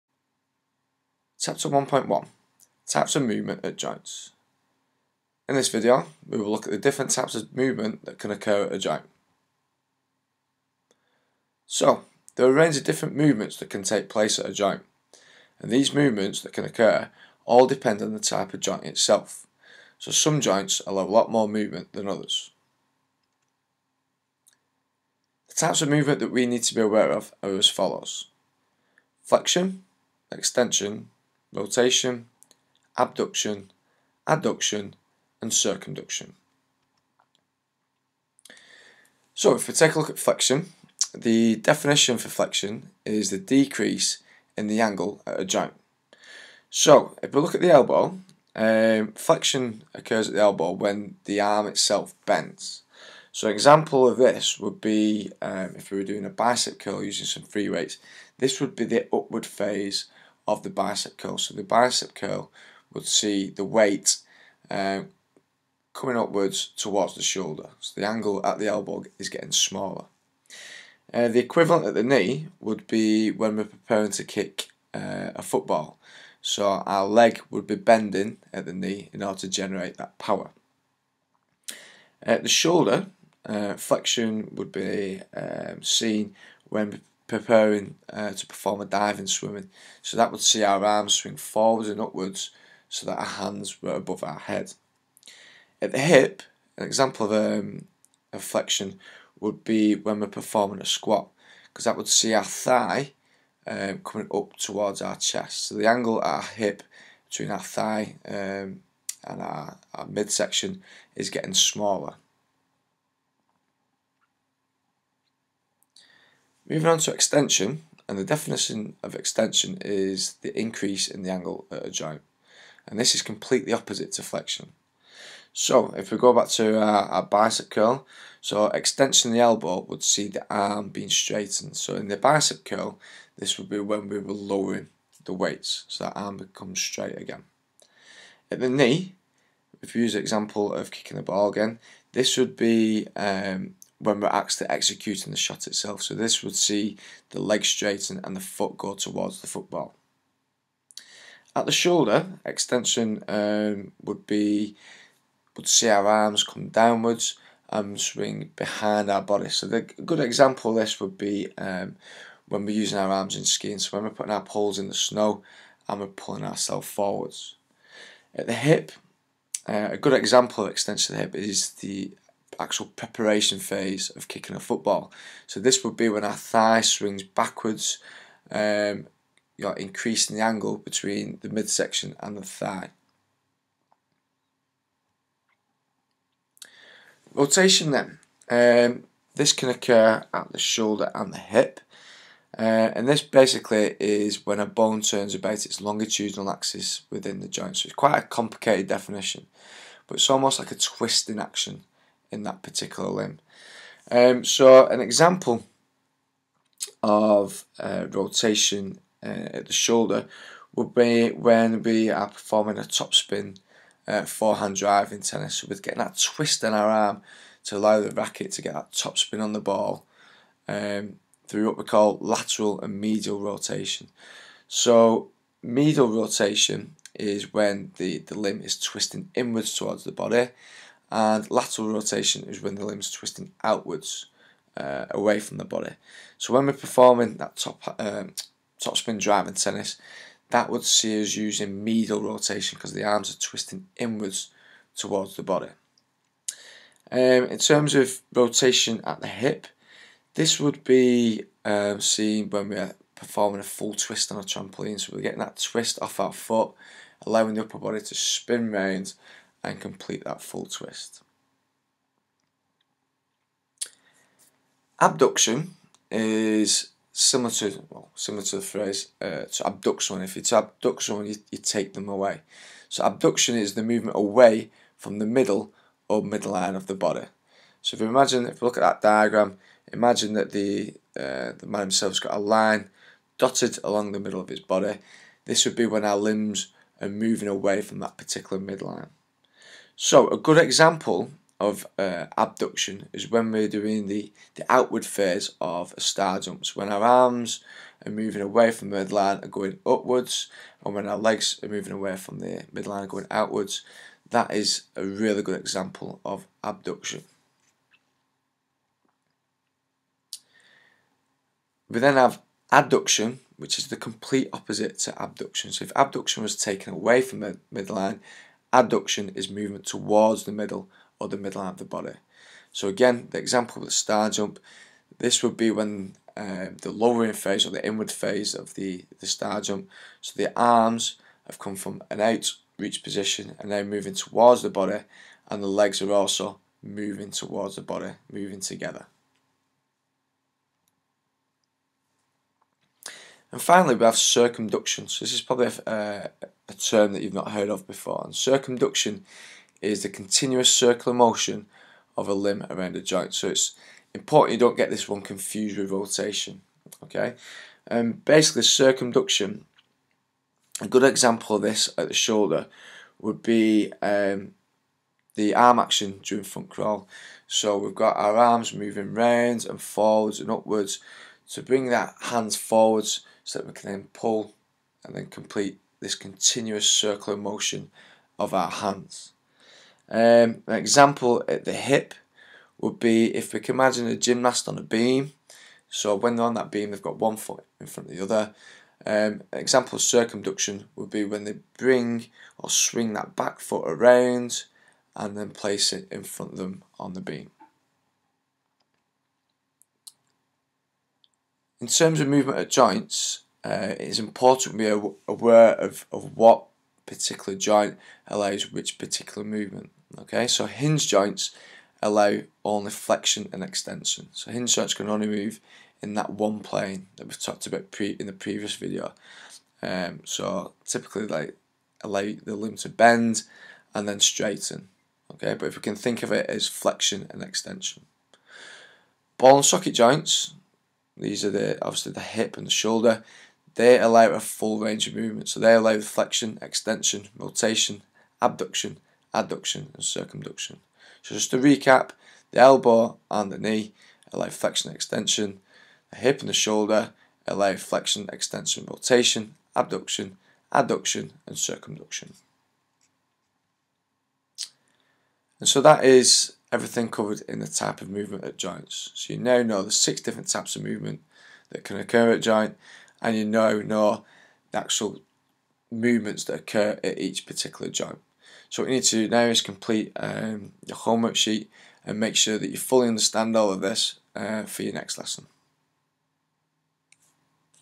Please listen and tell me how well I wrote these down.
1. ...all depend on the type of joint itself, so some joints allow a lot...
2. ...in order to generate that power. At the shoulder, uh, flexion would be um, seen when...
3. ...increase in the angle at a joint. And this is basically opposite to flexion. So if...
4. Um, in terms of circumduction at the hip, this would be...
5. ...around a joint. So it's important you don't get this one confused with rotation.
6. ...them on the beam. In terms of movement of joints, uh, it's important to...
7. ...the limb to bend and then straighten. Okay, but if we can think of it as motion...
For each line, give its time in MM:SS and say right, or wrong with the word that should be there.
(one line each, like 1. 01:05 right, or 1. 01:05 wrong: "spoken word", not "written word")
1. 00:17 right
2. 01:19 right
3. 02:00 wrong: "completely", not "basically"
4. 04:07 wrong: "rotation", not "circumduction"
5. 05:52 right
6. 06:36 right
7. 07:02 wrong: "flexion", not "motion".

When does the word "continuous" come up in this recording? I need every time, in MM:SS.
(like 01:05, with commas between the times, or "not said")
05:50, 06:16.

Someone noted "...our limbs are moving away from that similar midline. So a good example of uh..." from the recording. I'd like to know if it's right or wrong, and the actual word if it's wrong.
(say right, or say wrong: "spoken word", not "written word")
wrong: "particular", not "similar".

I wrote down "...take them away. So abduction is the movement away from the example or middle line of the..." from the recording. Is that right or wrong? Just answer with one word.
wrong.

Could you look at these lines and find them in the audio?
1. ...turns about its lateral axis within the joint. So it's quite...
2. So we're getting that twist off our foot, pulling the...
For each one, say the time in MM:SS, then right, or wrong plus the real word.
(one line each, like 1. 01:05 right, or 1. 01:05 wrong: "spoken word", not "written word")
1. 03:14 wrong: "longitudinal", not "lateral"
2. 04:14 wrong: "allowing", not "pulling".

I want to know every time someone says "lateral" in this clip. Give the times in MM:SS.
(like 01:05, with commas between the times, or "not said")
03:42, 03:51.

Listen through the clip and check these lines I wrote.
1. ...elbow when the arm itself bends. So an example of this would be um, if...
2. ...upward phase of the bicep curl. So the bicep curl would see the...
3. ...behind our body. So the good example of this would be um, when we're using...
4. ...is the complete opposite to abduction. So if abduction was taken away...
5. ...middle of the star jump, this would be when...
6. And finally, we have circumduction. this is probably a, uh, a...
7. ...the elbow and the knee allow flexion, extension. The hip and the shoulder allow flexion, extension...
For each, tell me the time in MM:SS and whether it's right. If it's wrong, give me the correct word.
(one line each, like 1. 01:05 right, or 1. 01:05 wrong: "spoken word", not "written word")
1. 00:50 right
2. 00:59 right
3. 02:38 right
4. 05:13 right
5. 05:23 wrong: "example", not "middle"
6. 05:43 right
7. 07:22 right.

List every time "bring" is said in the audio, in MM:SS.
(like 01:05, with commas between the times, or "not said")
06:11, 06:31.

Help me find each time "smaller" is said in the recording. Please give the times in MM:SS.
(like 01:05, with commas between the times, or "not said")
01:09, 01:51.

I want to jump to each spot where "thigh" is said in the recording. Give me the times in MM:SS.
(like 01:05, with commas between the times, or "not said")
01:42, 01:47, 02:56, 03:02.